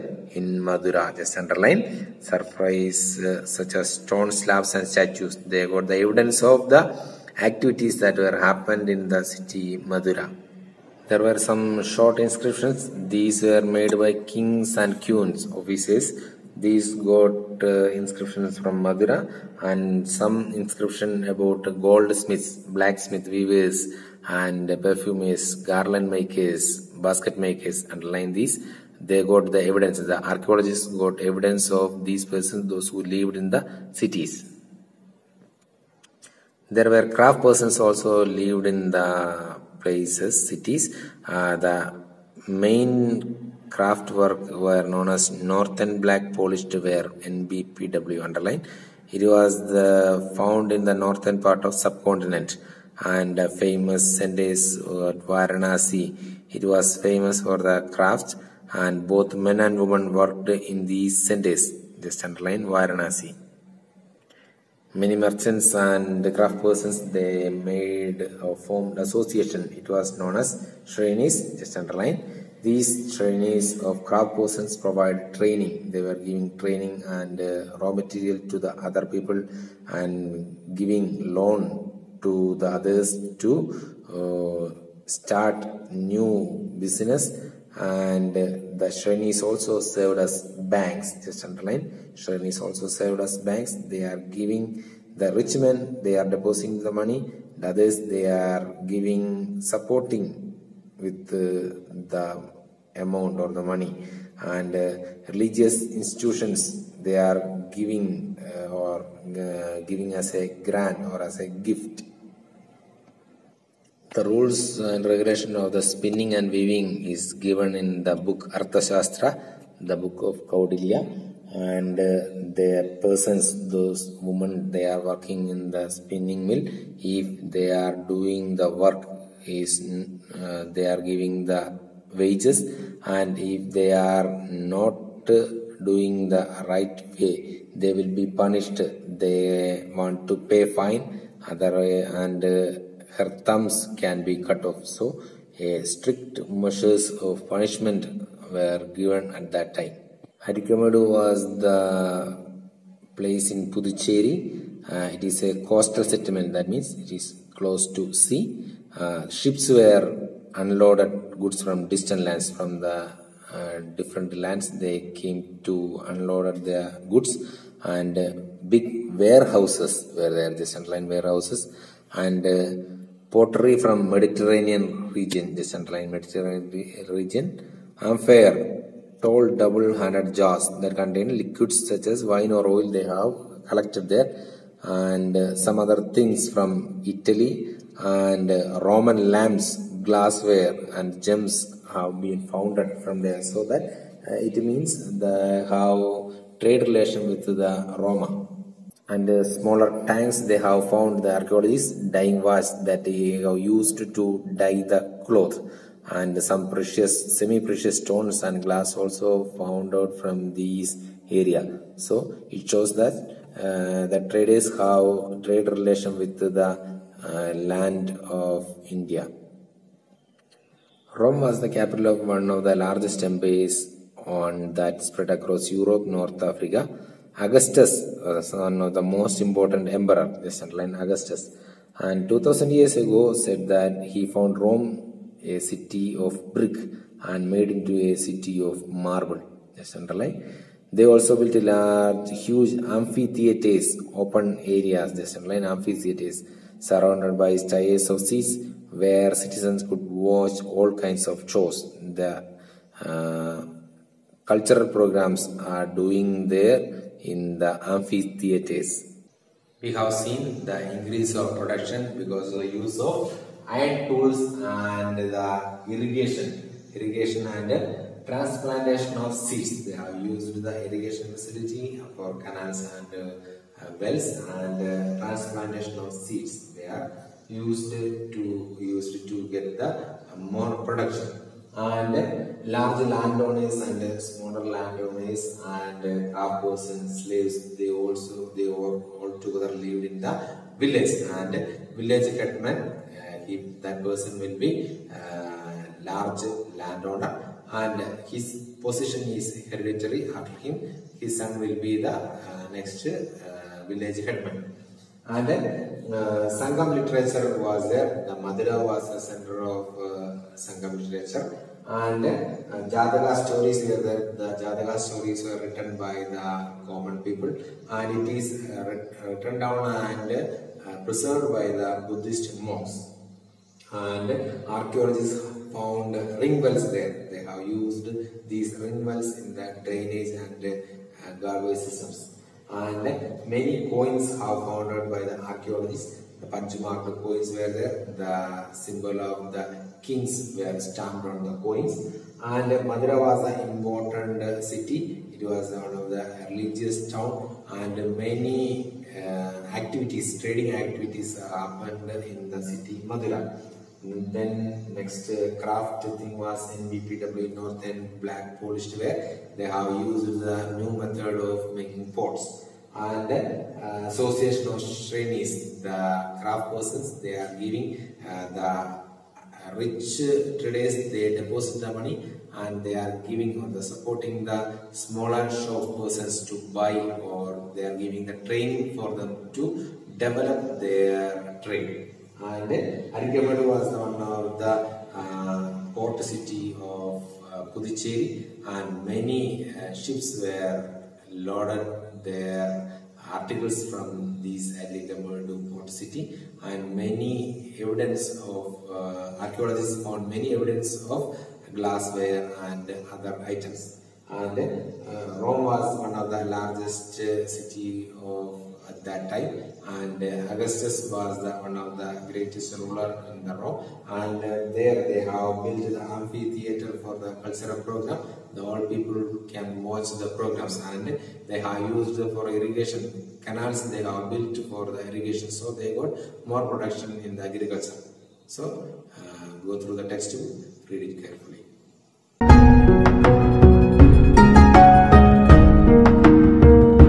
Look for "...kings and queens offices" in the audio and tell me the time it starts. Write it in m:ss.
0:14.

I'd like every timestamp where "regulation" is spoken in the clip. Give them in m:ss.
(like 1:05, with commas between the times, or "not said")
1:55.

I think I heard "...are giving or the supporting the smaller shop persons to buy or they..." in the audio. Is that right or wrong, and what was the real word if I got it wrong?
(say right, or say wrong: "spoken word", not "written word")
right.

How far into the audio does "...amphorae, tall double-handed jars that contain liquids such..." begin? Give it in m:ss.
2:58.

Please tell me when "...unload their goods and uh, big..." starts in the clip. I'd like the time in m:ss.
2:46.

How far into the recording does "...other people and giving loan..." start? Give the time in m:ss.
1:18.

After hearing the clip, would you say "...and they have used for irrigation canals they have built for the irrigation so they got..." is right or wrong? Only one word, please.
right.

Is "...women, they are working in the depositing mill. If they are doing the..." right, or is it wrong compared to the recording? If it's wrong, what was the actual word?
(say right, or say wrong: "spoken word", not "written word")
wrong: "spinning", not "depositing".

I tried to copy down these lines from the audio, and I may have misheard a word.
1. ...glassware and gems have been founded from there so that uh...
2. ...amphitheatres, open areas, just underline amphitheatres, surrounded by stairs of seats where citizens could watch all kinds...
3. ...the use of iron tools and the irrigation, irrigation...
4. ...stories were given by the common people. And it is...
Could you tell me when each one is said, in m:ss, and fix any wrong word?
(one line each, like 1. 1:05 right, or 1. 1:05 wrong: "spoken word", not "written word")
1. 3:10 right
2. 4:02 right
3. 4:22 right
4. 5:14 wrong: "written", not "given".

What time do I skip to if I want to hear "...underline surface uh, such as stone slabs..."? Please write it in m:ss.
0:01.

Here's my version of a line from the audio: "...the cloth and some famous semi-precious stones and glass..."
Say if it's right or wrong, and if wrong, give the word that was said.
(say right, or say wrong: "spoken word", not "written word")
wrong: "precious", not "famous".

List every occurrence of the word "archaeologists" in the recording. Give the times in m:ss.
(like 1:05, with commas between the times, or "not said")
0:30, 3:21, 5:24, 5:35, 6:39.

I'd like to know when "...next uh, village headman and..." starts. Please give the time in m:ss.
5:02.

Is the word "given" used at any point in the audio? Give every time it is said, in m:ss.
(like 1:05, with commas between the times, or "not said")
1:57, 2:28.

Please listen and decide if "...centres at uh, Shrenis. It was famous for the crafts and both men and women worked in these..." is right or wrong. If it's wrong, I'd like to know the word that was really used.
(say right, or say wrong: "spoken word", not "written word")
wrong: "Varanasi", not "Shrenis".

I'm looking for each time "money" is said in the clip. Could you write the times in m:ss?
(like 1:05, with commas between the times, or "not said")
1:37, 1:43, 6:11.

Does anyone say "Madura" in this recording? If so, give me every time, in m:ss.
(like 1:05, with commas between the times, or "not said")
0:00, 0:09, 0:18, 5:08, 5:42, 5:53.